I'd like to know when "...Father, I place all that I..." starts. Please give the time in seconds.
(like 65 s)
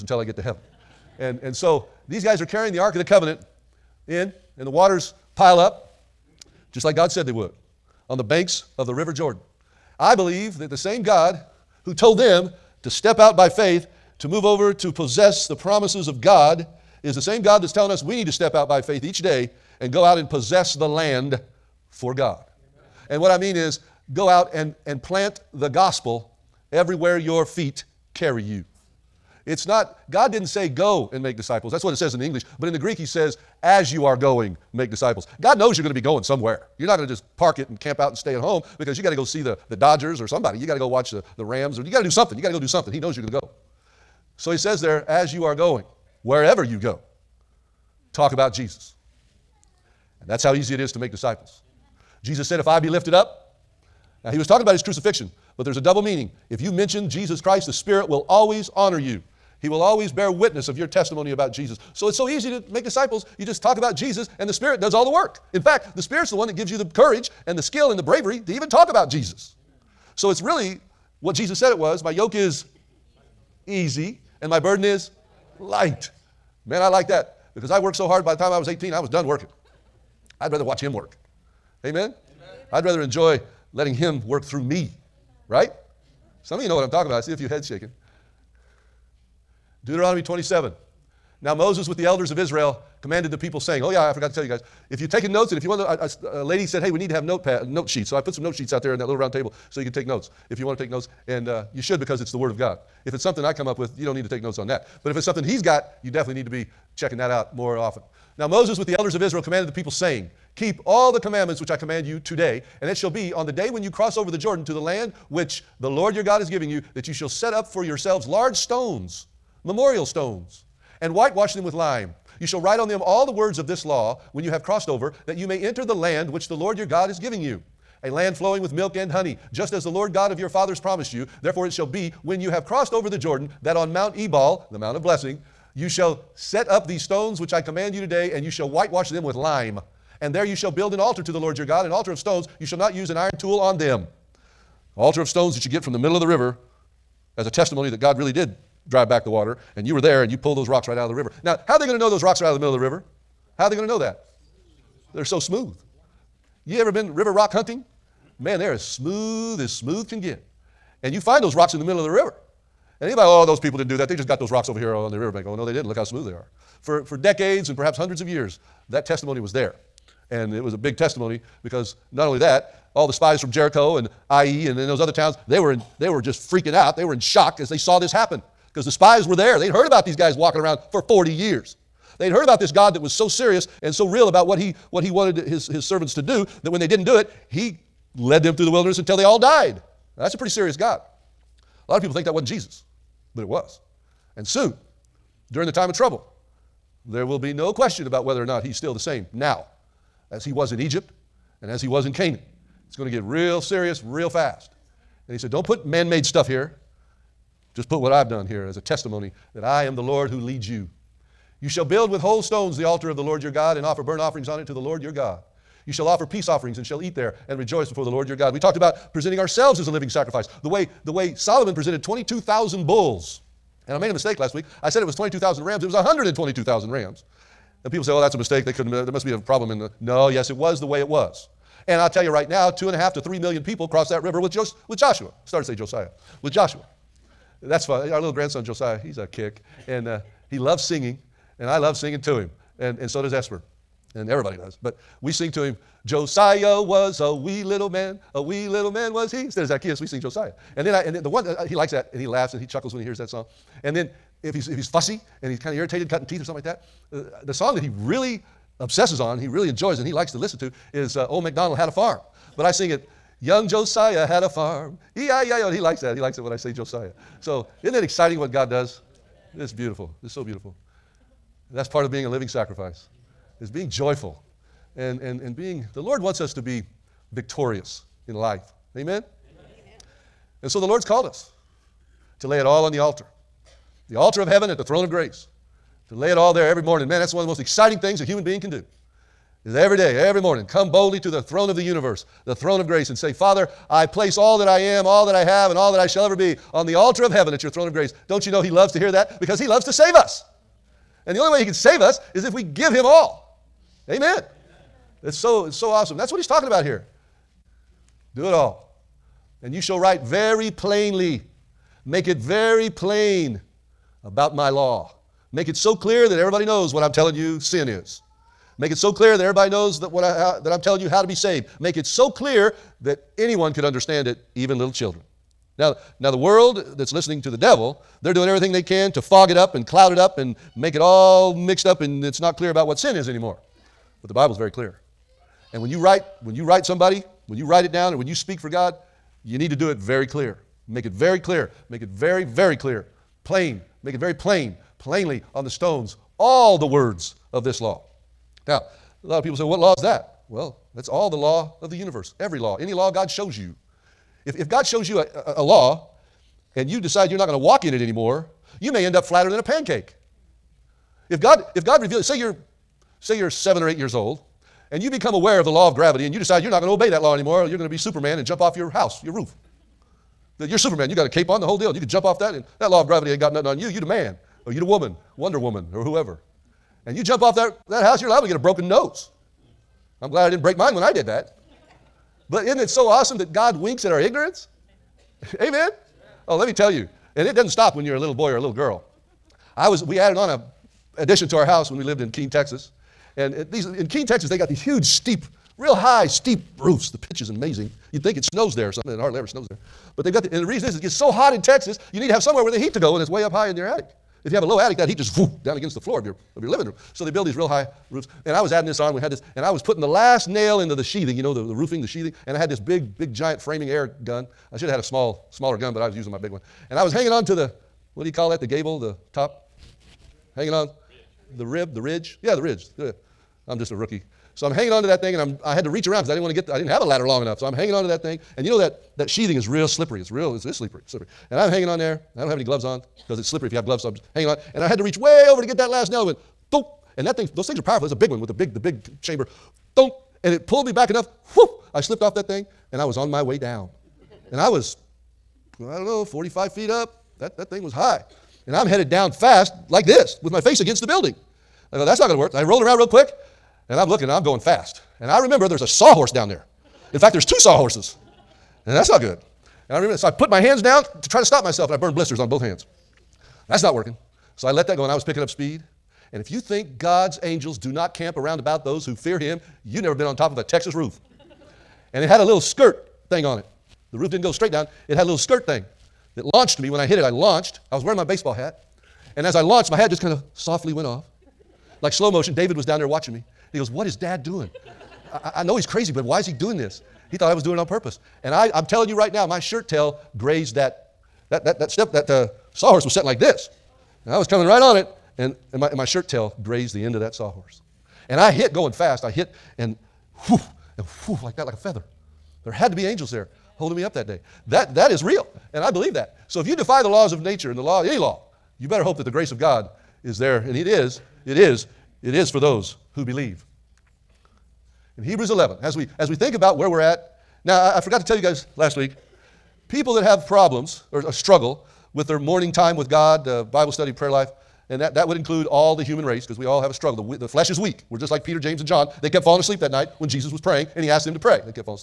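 293 s.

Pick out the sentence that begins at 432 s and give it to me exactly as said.
I don't have any gloves on because it's slippery if you have gloves, so I'm hanging on.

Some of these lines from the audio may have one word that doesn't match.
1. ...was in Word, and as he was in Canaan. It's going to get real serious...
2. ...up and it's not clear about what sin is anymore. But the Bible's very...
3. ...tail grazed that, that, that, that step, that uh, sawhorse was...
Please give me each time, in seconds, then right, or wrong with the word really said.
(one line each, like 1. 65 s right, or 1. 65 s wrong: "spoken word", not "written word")
1. 200 s wrong: "Egypt", not "Word"
2. 331 s right
3. 489 s right.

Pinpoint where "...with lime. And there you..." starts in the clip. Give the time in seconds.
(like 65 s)
139 s.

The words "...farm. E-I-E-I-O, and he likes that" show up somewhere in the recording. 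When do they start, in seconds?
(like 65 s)
264 s.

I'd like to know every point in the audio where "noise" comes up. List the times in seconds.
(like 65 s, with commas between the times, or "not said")
not said.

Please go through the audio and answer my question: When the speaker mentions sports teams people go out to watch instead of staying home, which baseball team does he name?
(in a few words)
Dodgers.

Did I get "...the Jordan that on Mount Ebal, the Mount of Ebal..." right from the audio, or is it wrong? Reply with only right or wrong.
wrong.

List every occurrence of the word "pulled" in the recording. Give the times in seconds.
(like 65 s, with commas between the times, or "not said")
150 s, 440 s.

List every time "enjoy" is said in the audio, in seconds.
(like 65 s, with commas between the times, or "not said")
83 s, 259 s.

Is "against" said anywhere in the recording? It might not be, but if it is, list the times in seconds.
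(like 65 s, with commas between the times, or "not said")
405 s, 450 s.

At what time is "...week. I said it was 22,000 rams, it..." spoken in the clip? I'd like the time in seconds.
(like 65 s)
224 s.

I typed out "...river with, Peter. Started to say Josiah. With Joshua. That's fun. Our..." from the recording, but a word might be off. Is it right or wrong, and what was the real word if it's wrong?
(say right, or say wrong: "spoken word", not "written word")
wrong: "Joshua", not "Peter".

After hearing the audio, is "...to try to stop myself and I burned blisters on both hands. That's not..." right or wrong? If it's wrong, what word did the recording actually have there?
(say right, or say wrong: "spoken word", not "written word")
right.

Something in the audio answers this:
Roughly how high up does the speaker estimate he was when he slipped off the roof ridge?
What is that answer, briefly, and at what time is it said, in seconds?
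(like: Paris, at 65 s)
45 feet, at 446 s.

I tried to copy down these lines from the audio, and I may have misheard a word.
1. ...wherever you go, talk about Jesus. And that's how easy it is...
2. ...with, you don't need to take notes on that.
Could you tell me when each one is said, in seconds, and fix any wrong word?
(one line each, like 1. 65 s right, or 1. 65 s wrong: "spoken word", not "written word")
1. 46 s right
2. 103 s right.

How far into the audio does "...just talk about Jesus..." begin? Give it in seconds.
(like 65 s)
63 s.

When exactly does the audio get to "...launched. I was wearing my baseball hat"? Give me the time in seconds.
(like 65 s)
477 s.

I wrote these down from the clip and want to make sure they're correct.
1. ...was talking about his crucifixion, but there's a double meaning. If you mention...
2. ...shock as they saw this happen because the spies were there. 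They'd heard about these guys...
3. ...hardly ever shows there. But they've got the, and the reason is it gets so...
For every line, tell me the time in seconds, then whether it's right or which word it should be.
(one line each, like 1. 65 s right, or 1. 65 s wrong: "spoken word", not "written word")
1. 54 s right
2. 177 s right
3. 399 s wrong: "snows", not "shows".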